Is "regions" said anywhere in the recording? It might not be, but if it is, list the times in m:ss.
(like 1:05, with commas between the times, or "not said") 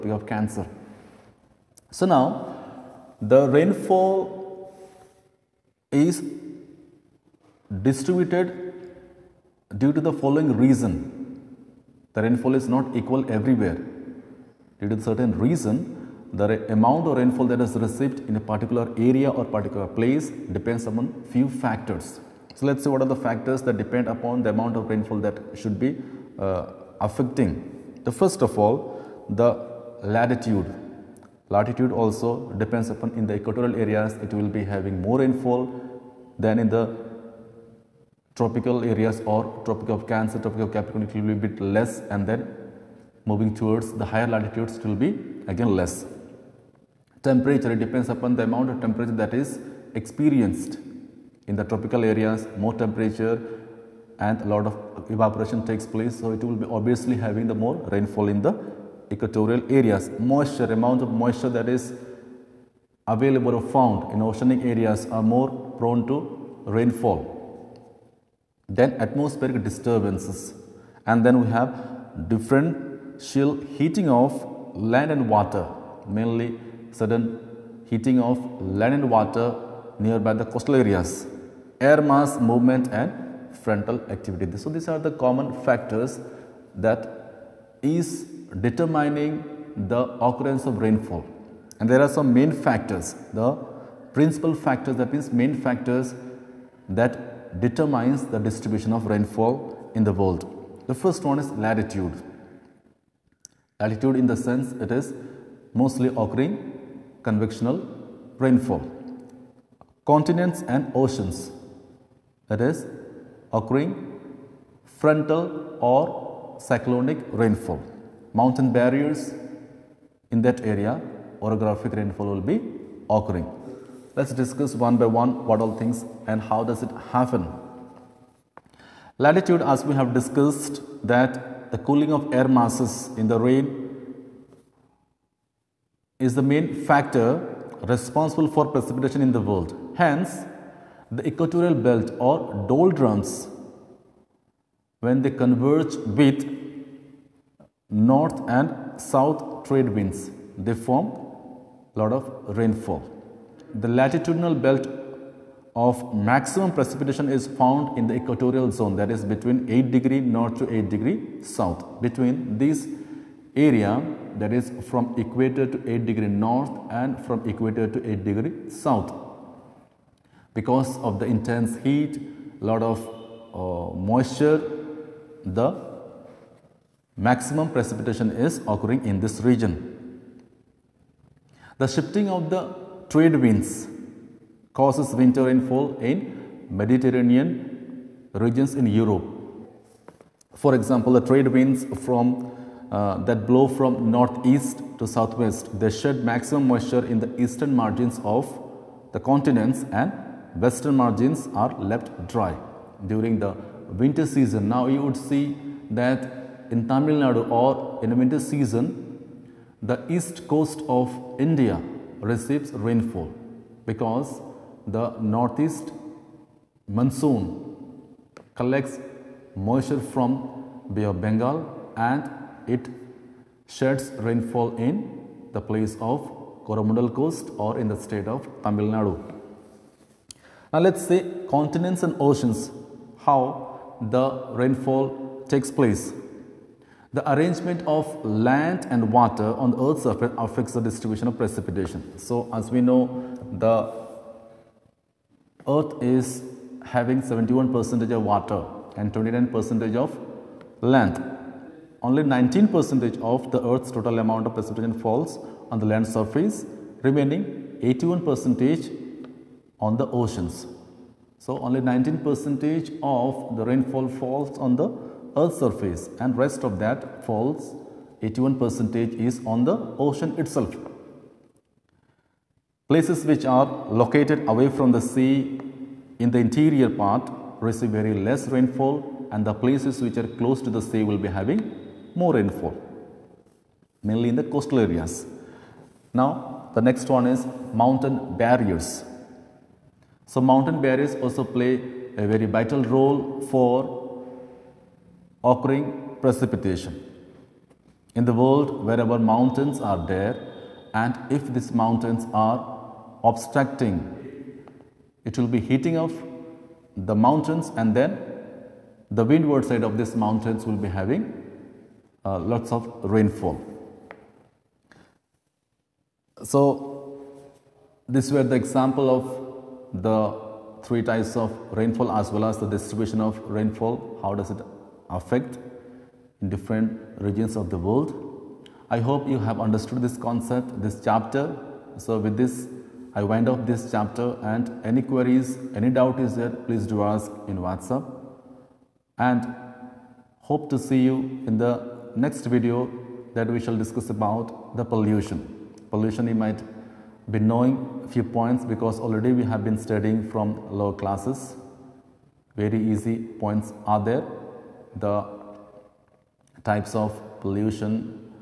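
2:59, 3:08, 5:27.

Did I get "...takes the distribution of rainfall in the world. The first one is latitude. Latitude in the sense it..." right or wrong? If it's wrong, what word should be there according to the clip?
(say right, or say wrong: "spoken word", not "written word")
wrong: "determines", not "takes".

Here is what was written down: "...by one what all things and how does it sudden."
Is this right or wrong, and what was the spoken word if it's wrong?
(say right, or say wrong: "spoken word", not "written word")
wrong: "happen", not "sudden".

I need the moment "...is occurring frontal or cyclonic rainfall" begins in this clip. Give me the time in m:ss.
1:52.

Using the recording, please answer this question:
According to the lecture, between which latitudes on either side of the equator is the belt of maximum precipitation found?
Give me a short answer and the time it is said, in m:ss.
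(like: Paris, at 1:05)
8 degrees north to 8 degrees south, at 2:39.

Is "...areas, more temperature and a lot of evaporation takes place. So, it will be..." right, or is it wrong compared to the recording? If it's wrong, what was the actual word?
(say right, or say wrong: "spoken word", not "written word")
right.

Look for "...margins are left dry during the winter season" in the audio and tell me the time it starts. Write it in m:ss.
3:20.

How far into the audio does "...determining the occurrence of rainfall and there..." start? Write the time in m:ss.
1:28.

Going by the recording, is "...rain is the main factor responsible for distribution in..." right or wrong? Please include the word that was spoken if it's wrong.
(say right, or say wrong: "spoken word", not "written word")
wrong: "precipitation", not "distribution".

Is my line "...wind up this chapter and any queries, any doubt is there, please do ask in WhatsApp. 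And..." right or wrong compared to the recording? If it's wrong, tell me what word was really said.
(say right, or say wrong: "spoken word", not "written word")
right.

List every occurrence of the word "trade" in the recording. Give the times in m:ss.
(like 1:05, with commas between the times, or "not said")
2:29, 3:03, 3:11.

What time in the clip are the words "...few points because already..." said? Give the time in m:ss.
5:48.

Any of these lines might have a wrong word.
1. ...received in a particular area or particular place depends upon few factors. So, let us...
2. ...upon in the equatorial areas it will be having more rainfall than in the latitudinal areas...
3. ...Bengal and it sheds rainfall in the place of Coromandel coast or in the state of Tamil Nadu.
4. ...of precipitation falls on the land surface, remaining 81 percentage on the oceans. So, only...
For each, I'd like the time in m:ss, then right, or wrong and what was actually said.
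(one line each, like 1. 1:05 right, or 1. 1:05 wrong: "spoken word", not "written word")
1. 0:17 right
2. 0:32 wrong: "tropical", not "latitudinal"
3. 3:41 right
4. 4:14 right.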